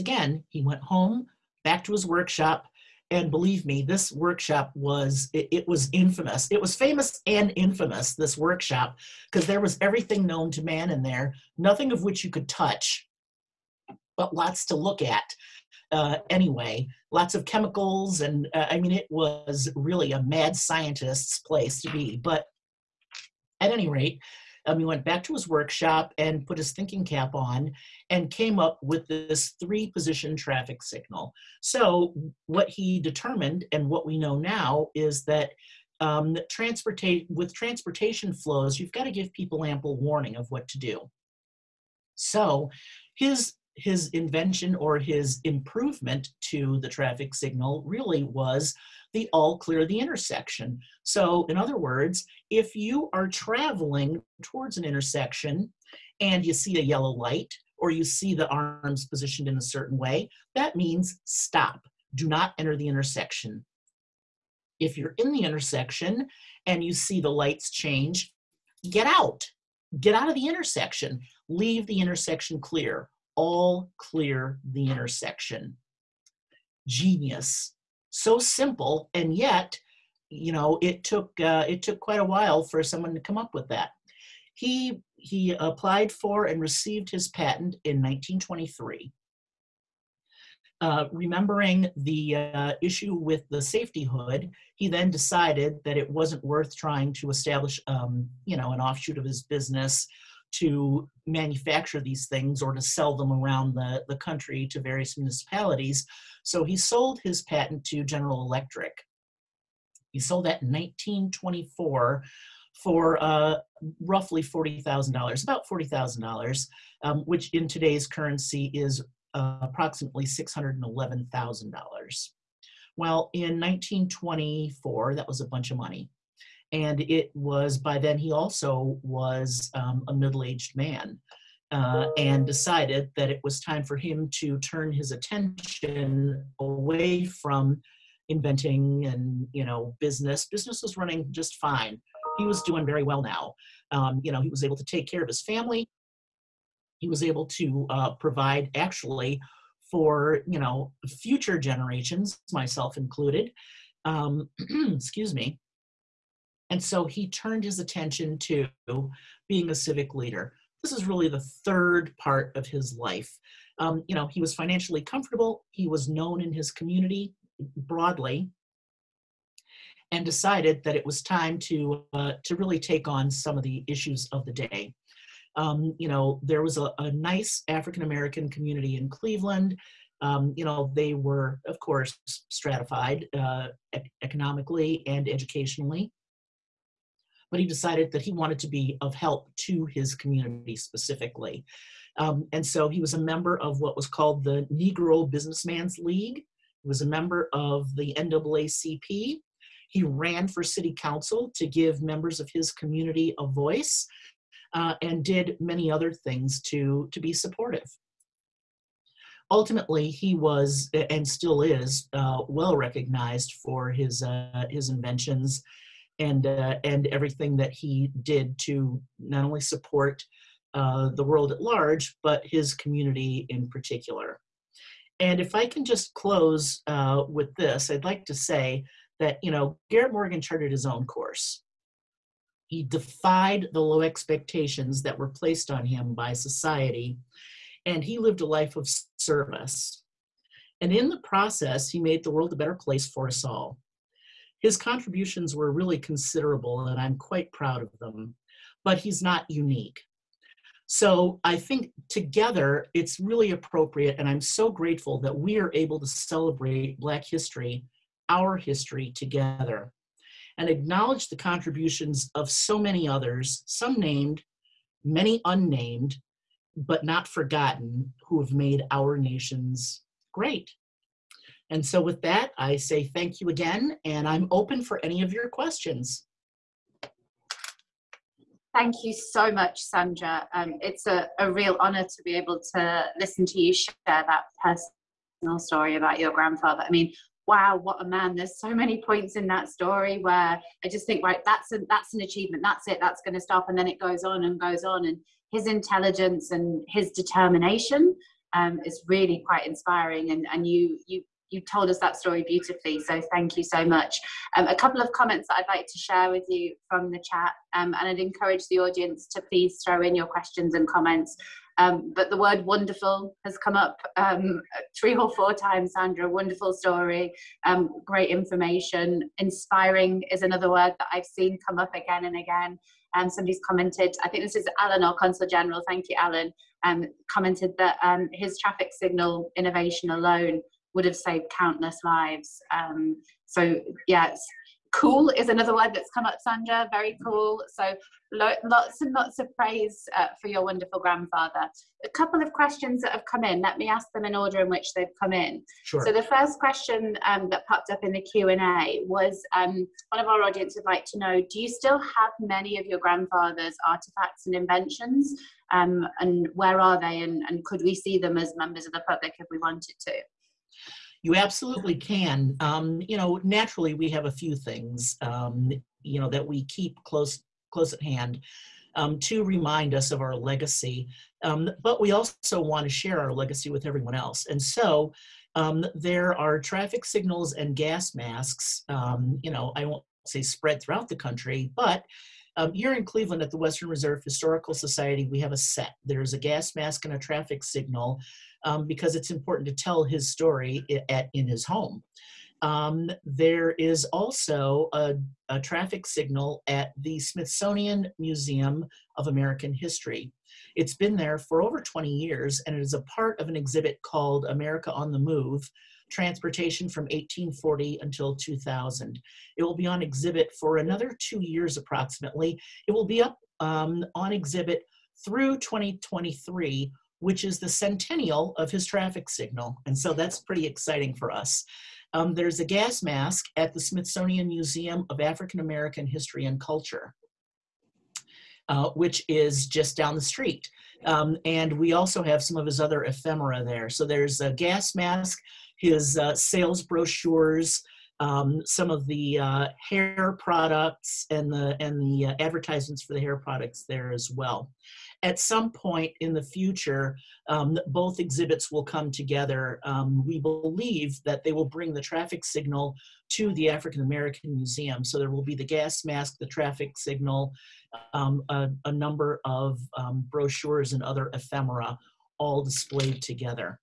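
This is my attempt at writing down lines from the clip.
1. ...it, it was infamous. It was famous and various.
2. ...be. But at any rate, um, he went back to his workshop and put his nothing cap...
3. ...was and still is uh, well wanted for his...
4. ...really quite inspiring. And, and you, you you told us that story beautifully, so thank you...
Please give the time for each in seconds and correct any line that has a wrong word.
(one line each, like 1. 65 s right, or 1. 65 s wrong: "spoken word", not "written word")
1. 5 s wrong: "infamous", not "various"
2. 21 s wrong: "thinking", not "nothing"
3. 210 s wrong: "recognized", not "wanted"
4. 299 s right.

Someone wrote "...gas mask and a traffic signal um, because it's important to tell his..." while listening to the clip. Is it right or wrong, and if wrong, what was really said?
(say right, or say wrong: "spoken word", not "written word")
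right.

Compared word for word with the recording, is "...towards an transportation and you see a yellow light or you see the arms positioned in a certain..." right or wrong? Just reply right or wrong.
wrong.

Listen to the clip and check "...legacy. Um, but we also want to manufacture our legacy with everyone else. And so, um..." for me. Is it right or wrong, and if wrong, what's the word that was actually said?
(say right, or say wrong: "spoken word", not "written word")
wrong: "share", not "manufacture".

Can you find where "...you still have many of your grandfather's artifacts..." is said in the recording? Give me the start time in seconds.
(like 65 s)
351 s.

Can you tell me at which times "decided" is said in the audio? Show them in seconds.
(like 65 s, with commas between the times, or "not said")
95 s, 132 s, 170 s, 187 s.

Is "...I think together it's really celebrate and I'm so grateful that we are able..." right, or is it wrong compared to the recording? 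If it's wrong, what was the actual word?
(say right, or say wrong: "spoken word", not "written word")
wrong: "appropriate", not "celebrate".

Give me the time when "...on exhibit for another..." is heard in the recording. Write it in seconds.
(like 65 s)
409 s.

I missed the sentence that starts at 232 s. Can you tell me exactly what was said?
He defied the low expectations that were placed on him by society, and he lived a life of service.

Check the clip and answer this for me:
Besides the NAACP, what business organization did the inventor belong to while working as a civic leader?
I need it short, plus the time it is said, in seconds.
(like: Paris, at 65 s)
Negro Businessman's League, at 194 s.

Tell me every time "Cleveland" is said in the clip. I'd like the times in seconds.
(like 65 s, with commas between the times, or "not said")
179 s, 383 s.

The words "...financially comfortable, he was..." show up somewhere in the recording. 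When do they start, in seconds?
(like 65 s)
164 s.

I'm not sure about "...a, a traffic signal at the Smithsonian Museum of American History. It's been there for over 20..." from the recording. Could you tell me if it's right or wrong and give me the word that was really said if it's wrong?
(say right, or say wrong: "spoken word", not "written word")
right.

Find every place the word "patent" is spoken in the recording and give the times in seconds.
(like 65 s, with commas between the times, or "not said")
87 s, 107 s.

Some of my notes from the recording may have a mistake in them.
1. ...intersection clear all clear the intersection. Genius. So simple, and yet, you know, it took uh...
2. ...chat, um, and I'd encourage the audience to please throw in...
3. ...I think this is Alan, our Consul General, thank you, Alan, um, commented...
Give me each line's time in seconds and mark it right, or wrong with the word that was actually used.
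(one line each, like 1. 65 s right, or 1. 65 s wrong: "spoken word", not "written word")
1. 72 s right
2. 307 s right
3. 324 s right.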